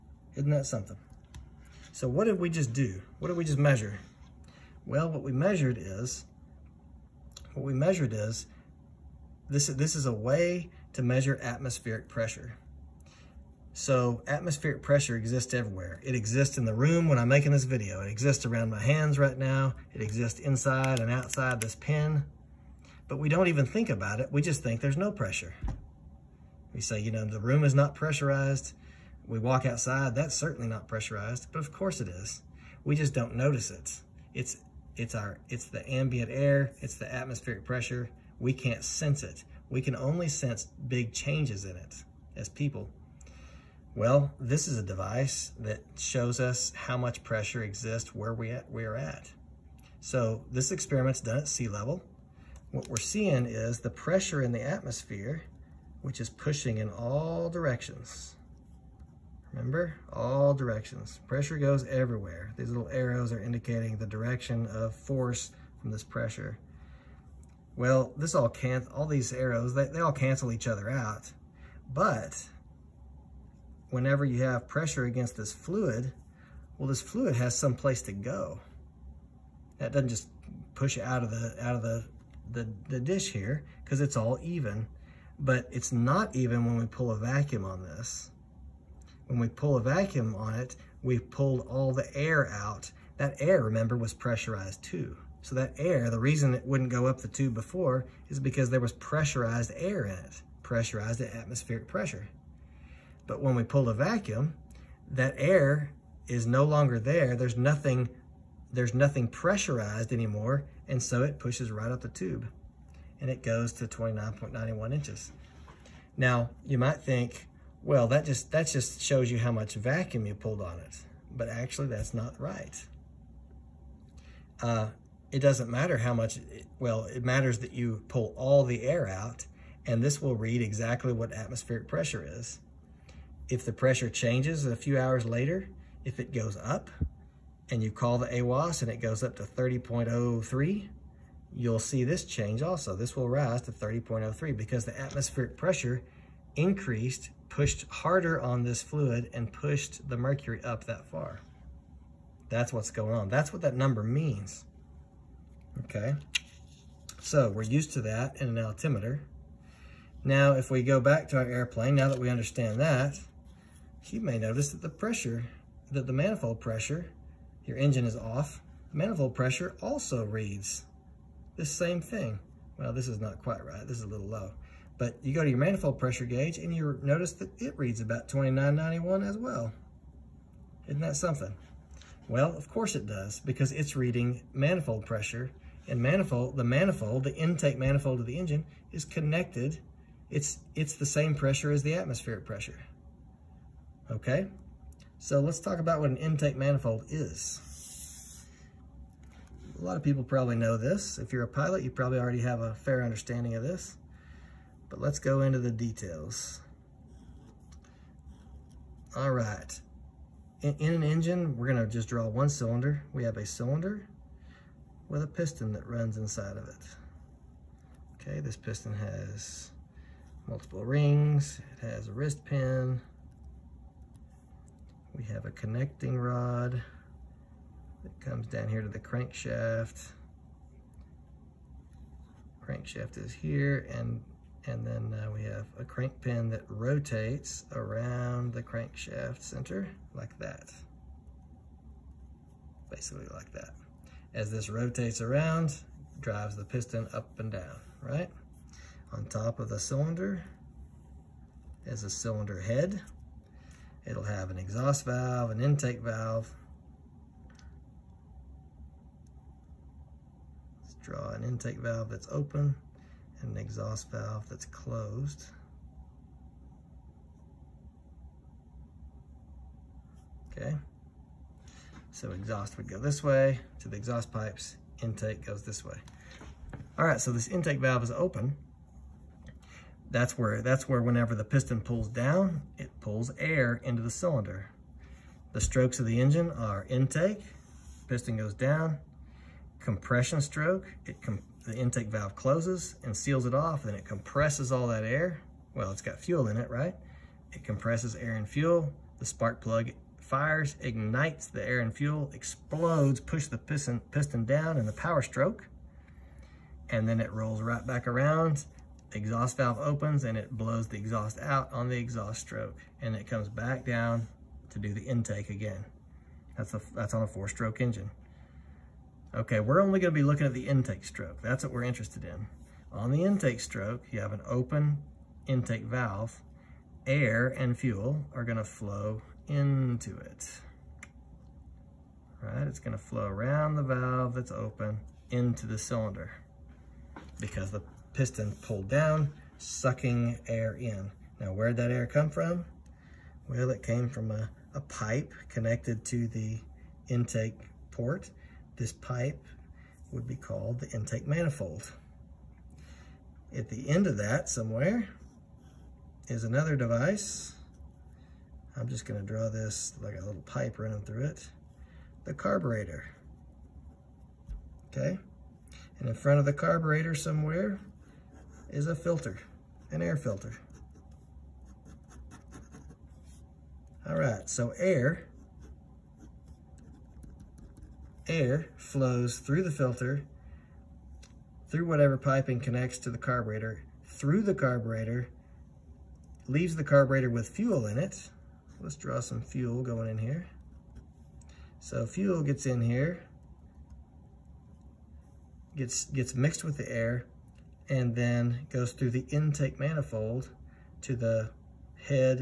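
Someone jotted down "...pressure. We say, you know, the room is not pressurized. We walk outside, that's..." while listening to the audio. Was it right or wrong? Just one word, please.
right.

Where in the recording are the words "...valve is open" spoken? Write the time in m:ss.
4:37.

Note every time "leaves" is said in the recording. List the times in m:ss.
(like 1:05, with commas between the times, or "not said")
6:26.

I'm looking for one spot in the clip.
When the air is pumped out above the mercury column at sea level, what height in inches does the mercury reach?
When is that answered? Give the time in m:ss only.
1:53.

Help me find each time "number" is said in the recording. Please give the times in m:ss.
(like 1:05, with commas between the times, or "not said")
2:33.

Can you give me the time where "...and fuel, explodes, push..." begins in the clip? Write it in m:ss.
5:01.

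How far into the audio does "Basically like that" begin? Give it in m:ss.
4:02.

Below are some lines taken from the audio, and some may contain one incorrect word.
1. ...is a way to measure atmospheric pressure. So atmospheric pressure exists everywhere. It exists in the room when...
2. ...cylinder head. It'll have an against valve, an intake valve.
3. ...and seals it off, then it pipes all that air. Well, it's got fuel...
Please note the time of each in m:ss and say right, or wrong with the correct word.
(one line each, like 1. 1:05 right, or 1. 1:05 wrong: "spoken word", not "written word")
1. 0:09 right
2. 4:12 wrong: "exhaust", not "against"
3. 4:53 wrong: "compresses", not "pipes".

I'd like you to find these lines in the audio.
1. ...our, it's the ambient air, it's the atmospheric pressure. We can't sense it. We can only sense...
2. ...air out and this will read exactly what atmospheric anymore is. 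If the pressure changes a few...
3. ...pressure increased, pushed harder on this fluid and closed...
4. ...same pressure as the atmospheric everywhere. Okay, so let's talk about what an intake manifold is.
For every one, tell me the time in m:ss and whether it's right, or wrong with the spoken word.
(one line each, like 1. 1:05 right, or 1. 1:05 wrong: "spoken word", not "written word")
1. 0:35 right
2. 2:08 wrong: "pressure", not "anymore"
3. 2:25 wrong: "pushed", not "closed"
4. 3:11 wrong: "pressure", not "everywhere".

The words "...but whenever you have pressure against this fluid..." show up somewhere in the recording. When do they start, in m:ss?
1:11.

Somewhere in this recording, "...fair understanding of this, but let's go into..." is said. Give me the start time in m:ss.
3:22.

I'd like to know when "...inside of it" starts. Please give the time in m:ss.
3:36.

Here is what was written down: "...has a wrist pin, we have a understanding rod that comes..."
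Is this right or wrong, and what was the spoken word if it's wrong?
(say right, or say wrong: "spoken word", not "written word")
wrong: "connecting", not "understanding".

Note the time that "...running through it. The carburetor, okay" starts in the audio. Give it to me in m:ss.
6:00.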